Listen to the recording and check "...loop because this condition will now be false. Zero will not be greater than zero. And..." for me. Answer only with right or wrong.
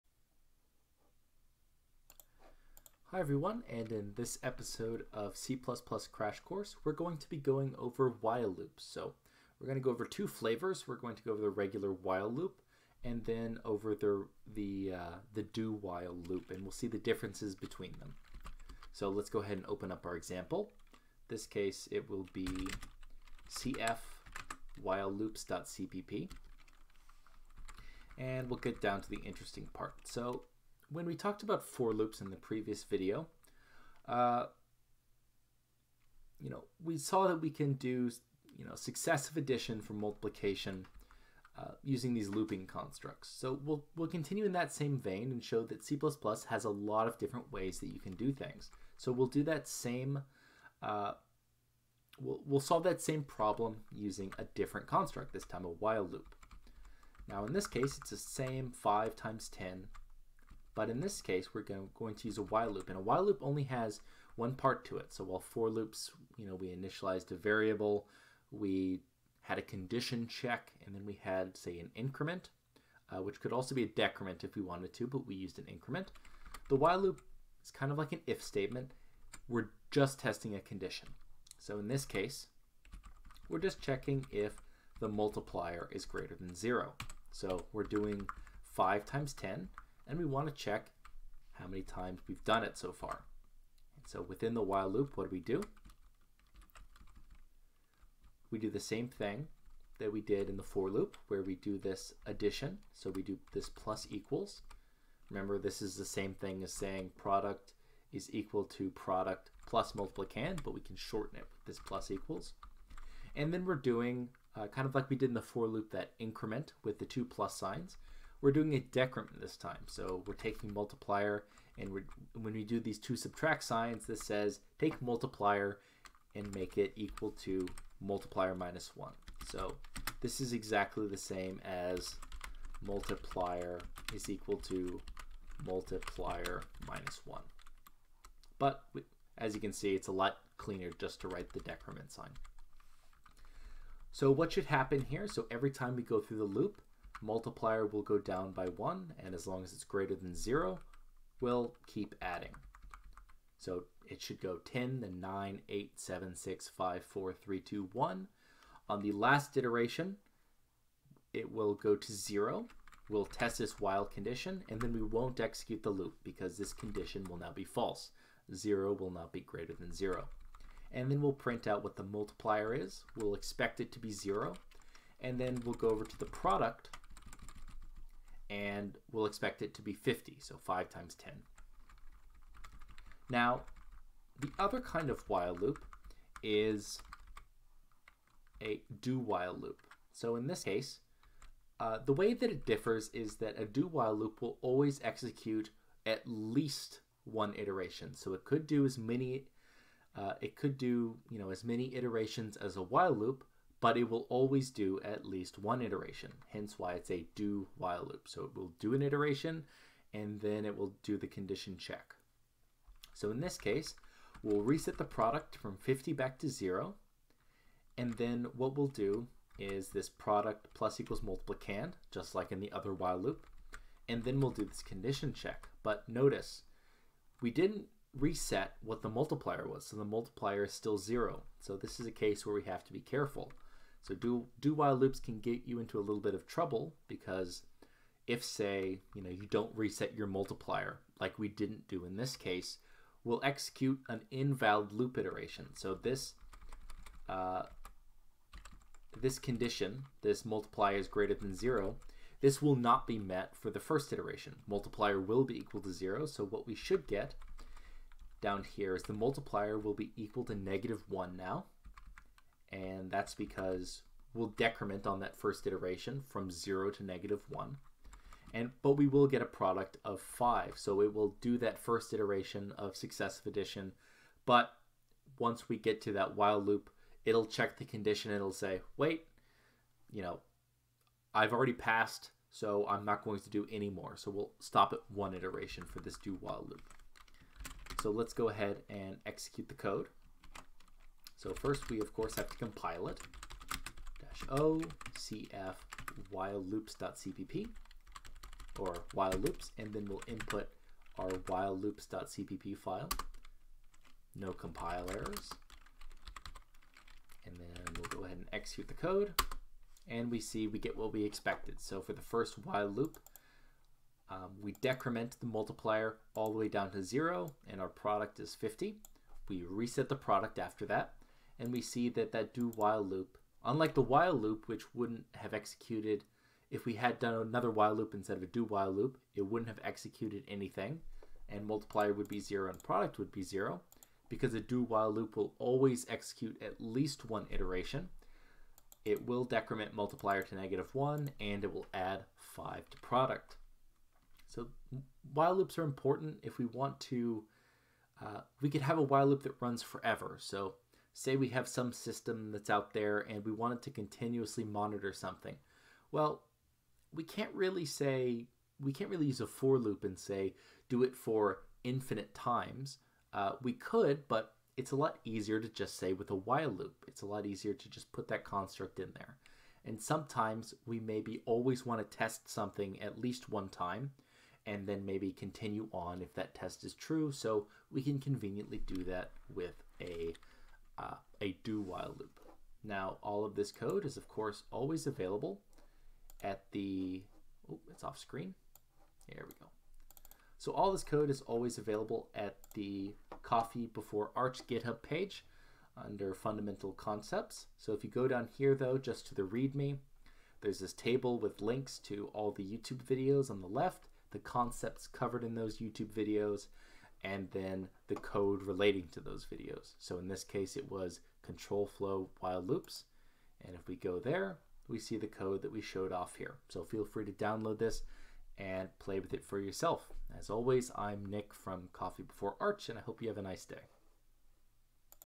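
right.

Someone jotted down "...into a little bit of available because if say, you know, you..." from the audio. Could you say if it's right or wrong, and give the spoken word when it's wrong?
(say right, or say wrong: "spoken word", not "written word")
wrong: "trouble", not "available".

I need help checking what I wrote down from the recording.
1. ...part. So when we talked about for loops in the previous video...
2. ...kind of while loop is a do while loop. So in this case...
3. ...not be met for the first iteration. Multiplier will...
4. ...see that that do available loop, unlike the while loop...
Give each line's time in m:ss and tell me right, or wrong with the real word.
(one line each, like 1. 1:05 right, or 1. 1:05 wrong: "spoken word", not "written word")
1. 0:29 right
2. 3:04 right
3. 4:12 right
4. 5:21 wrong: "while", not "available".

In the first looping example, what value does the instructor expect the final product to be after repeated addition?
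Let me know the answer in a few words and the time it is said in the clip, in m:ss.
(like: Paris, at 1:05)
50, at 2:59.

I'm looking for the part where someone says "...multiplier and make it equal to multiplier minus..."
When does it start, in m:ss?
2:05.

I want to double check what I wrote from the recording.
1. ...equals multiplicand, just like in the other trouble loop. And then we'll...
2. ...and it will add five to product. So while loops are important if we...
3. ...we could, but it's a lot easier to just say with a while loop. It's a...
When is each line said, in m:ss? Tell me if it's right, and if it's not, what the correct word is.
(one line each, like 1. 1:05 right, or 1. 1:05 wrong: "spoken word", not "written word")
1. 3:40 wrong: "while", not "trouble"
2. 5:41 right
3. 6:03 right.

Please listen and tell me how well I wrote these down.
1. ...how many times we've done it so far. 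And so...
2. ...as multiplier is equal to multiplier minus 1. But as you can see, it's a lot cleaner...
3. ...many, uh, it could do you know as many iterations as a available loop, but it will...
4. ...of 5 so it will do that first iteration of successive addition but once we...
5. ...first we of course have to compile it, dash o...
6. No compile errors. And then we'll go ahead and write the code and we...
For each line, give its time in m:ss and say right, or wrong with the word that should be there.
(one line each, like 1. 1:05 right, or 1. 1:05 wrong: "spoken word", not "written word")
1. 1:31 right
2. 2:11 right
3. 3:18 wrong: "while", not "available"
4. 4:30 right
5. 4:51 right
6. 5:04 wrong: "execute", not "write".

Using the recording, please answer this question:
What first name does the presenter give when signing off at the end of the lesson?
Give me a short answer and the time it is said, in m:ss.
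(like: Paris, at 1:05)
Nick, at 7:00.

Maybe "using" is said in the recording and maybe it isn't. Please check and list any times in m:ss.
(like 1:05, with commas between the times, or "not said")
0:41, 0:53.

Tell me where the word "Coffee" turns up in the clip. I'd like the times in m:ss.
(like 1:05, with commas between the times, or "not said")
6:33, 7:01.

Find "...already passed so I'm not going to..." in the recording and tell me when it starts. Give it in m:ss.
4:41.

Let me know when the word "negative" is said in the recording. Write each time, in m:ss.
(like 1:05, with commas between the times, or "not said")
4:20, 4:27, 5:40.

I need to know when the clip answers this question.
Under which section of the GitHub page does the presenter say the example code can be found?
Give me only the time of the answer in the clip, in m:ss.
6:36.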